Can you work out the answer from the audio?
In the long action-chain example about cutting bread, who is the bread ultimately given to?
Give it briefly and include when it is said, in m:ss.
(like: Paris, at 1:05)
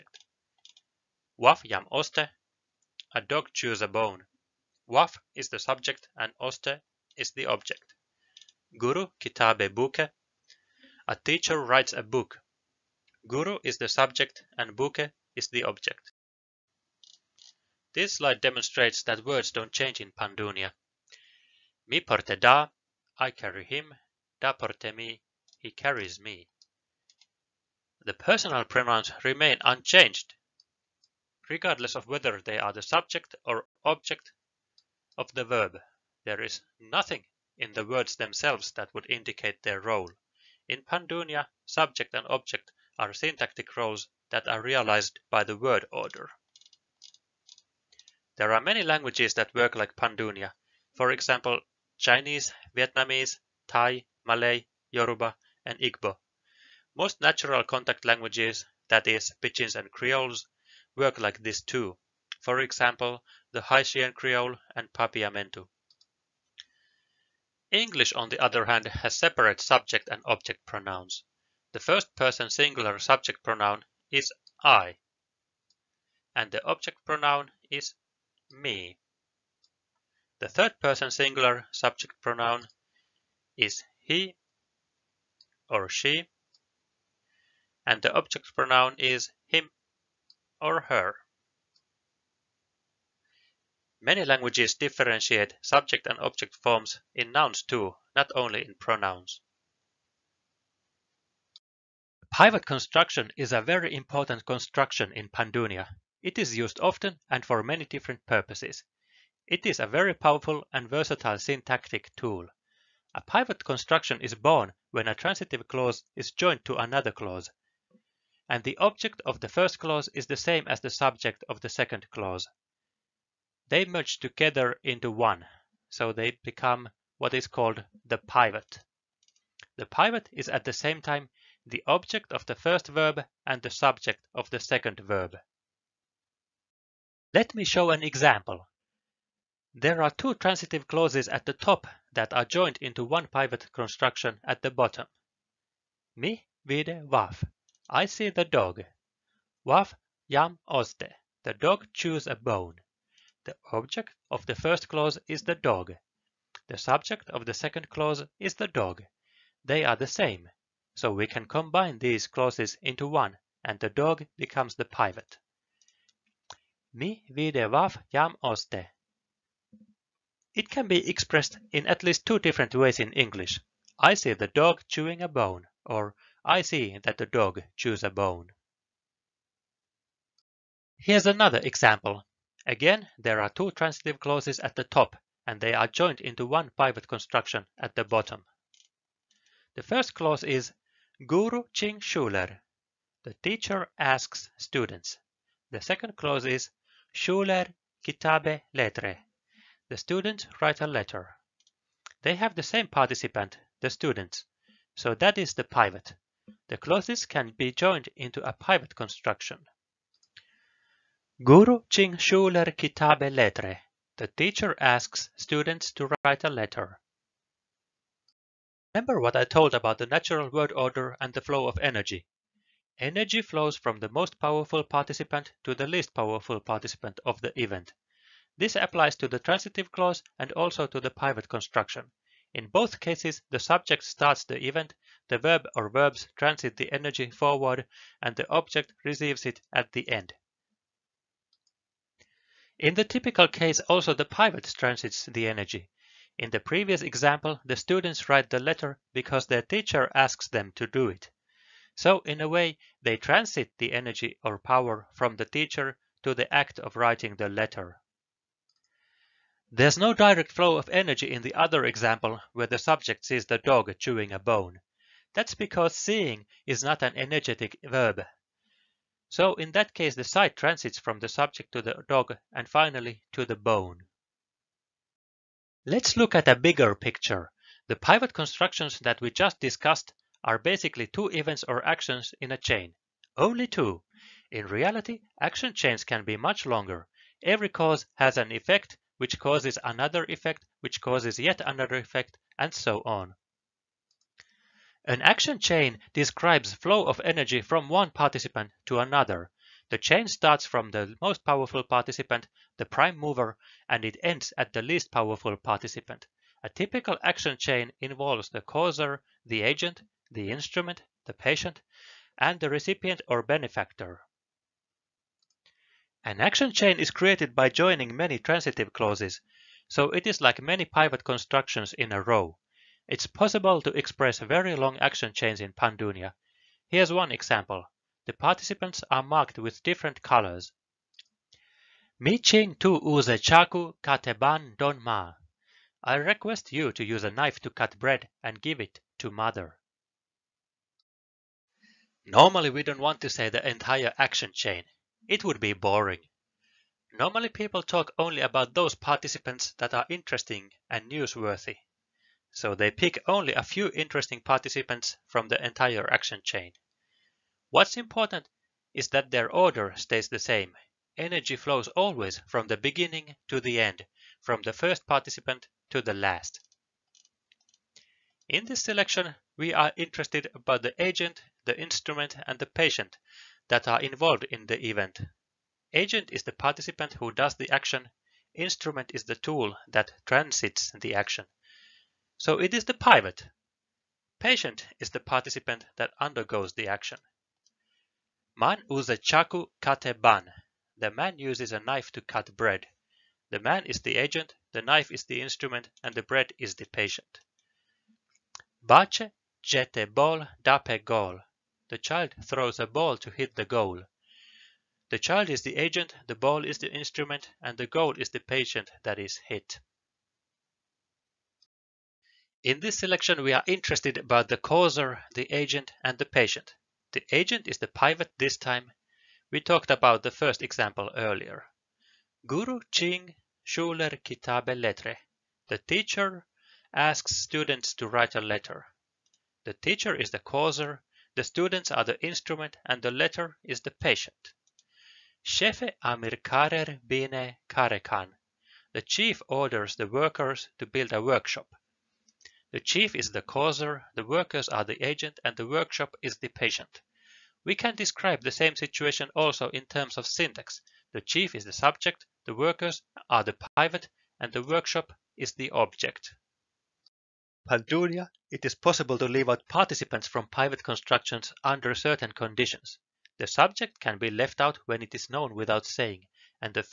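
mother, at 5:39.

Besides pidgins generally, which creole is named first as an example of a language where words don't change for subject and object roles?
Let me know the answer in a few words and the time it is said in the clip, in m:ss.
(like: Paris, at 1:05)
Haitian Creole, at 1:03.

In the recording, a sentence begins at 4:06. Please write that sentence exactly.
In the previous example, the students write the letter because their teacher asks them to do it.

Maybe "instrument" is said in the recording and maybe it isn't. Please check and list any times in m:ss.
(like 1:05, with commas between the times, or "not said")
5:10, 6:11, 6:18, 6:35, 6:46, 7:12.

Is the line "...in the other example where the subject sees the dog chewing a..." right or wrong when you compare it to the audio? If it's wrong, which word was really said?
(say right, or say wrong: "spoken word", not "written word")
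right.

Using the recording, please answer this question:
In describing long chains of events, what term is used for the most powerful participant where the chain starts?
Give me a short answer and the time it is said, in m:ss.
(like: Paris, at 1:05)
the prime mover, at 5:02.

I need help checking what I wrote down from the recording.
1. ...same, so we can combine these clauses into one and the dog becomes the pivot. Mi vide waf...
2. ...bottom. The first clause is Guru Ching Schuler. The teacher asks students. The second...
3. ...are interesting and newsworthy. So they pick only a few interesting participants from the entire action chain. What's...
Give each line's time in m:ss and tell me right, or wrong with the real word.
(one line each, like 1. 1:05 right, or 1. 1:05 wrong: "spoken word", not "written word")
1. 2:40 right
2. 3:08 right
3. 5:49 right.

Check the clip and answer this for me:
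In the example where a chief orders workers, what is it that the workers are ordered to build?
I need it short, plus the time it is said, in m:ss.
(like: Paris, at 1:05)
a workshop, at 7:21.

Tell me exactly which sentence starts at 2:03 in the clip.
They merge together into one, so they become what is called the pivot.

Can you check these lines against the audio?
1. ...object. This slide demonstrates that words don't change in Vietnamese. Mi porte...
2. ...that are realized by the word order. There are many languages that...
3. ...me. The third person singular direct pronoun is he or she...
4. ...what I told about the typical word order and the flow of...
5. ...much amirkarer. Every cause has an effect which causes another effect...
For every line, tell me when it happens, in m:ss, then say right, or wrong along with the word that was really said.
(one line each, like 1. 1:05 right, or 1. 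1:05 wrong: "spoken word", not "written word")
1. 0:15 wrong: "Pandunia", not "Vietnamese"
2. 0:44 right
3. 1:18 wrong: "subject", not "direct"
4. 3:39 wrong: "natural", not "typical"
5. 4:46 wrong: "longer", not "amirkarer".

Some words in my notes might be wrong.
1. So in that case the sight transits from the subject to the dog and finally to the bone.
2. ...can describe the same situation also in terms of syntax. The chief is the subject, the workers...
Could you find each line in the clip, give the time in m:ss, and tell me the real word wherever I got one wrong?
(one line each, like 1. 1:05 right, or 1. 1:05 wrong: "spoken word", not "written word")
1. 4:29 right
2. 7:27 right.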